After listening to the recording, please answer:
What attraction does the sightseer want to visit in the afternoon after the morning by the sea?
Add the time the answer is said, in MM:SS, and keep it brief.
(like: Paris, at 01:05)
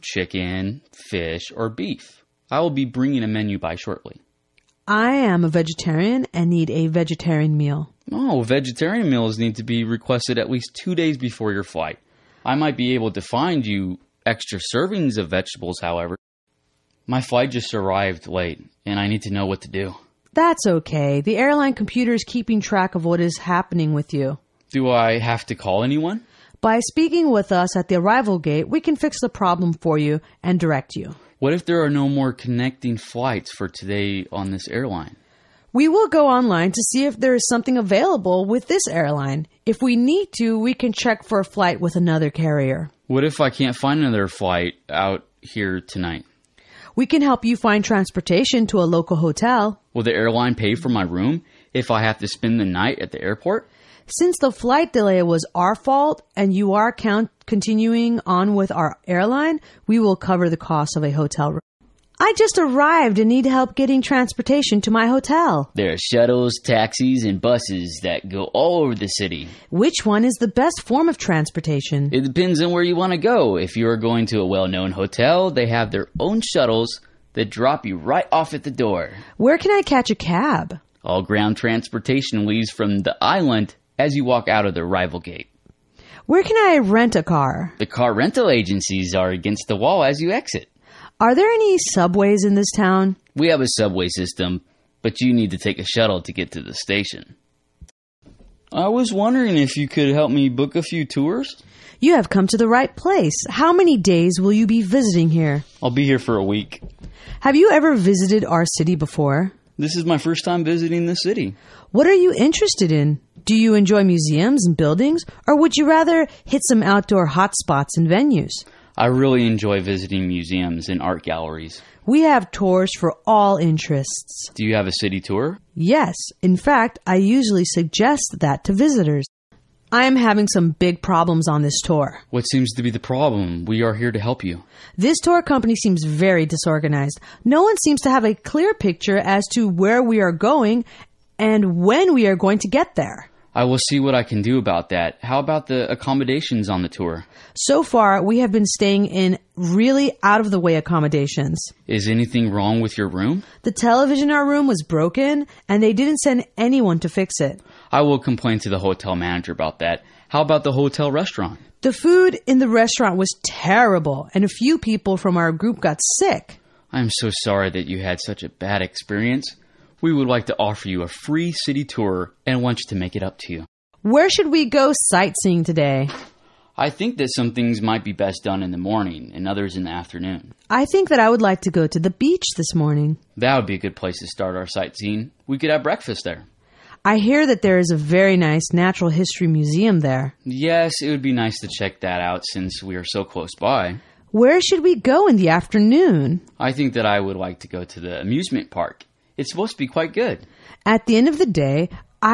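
amusement park, at 03:18.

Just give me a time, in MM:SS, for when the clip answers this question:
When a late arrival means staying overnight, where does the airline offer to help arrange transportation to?
00:48.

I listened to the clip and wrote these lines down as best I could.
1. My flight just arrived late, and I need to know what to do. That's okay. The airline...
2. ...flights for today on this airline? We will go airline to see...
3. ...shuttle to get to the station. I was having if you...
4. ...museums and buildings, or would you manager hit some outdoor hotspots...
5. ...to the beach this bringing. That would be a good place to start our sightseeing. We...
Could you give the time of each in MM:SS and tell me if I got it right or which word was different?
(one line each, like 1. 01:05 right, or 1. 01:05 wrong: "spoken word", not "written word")
1. 00:17 right
2. 00:32 wrong: "online", not "airline"
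3. 01:35 wrong: "wondering", not "having"
4. 01:54 wrong: "rather", not "manager"
5. 03:01 wrong: "morning", not "bringing".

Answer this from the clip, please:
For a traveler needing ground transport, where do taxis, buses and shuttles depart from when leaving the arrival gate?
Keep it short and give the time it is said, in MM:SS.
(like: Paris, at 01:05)
the island, at 01:22.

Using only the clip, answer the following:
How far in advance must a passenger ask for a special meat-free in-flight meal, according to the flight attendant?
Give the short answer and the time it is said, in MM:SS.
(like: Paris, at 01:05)
2 days, at 00:10.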